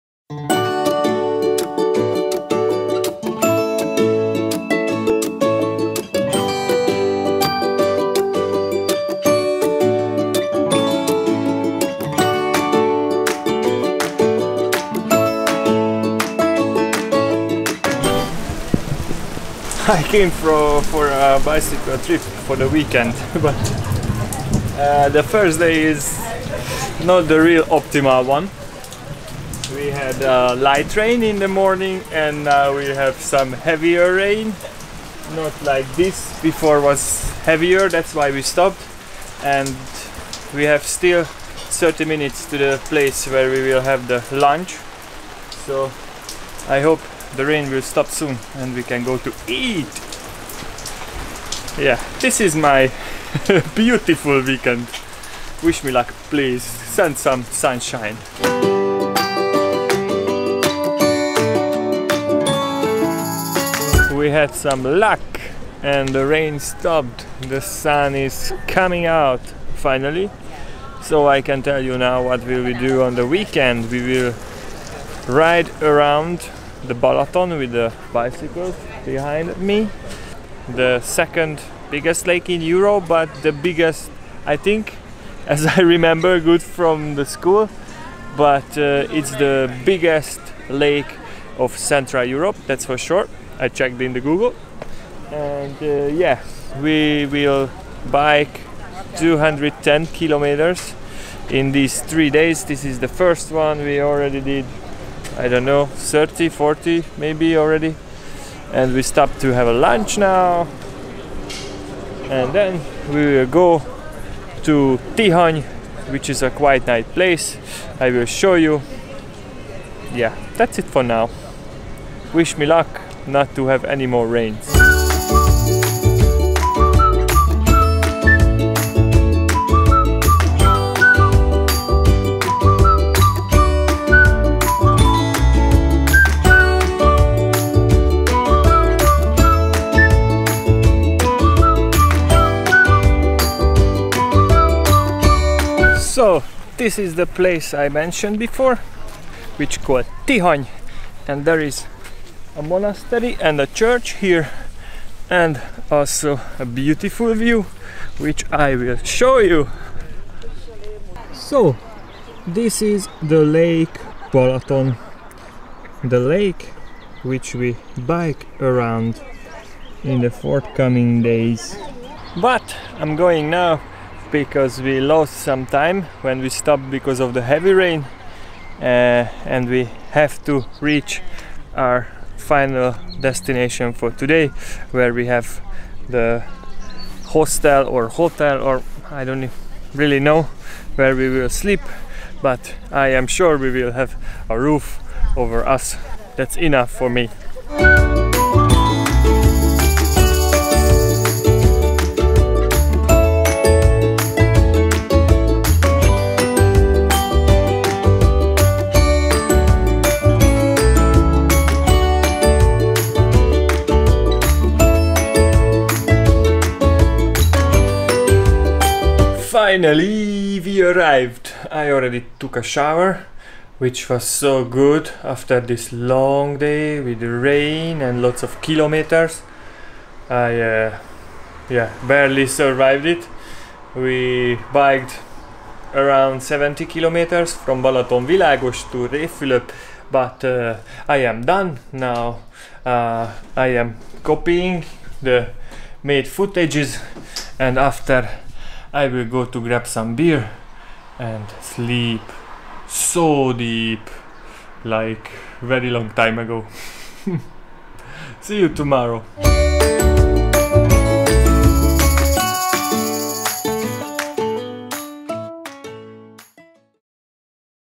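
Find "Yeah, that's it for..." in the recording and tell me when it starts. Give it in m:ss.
2:00.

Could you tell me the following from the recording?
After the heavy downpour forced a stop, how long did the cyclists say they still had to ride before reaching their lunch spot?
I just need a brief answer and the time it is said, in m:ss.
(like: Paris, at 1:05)
30 minutes, at 0:41.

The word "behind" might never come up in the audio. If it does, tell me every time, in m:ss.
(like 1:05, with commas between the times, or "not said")
1:19.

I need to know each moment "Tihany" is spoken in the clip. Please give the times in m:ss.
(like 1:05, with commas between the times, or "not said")
1:55, 2:30.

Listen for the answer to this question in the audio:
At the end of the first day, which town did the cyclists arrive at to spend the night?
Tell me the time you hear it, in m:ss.
3:59.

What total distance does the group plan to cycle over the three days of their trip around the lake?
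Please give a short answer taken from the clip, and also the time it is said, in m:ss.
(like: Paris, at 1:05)
210 kilometers, at 1:39.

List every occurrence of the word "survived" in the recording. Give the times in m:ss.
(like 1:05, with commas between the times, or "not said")
3:52.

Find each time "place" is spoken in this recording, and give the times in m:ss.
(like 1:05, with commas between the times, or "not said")
0:42, 1:57, 2:27.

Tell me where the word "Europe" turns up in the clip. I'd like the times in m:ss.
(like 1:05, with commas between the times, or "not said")
1:22, 1:32.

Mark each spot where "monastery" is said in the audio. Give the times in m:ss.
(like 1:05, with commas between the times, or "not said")
2:32.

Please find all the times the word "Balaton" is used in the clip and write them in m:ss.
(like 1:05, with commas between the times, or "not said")
1:16, 2:44, 3:57.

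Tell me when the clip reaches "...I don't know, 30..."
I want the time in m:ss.
1:45.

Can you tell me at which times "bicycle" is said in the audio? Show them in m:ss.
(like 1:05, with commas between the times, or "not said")
0:21, 1:18.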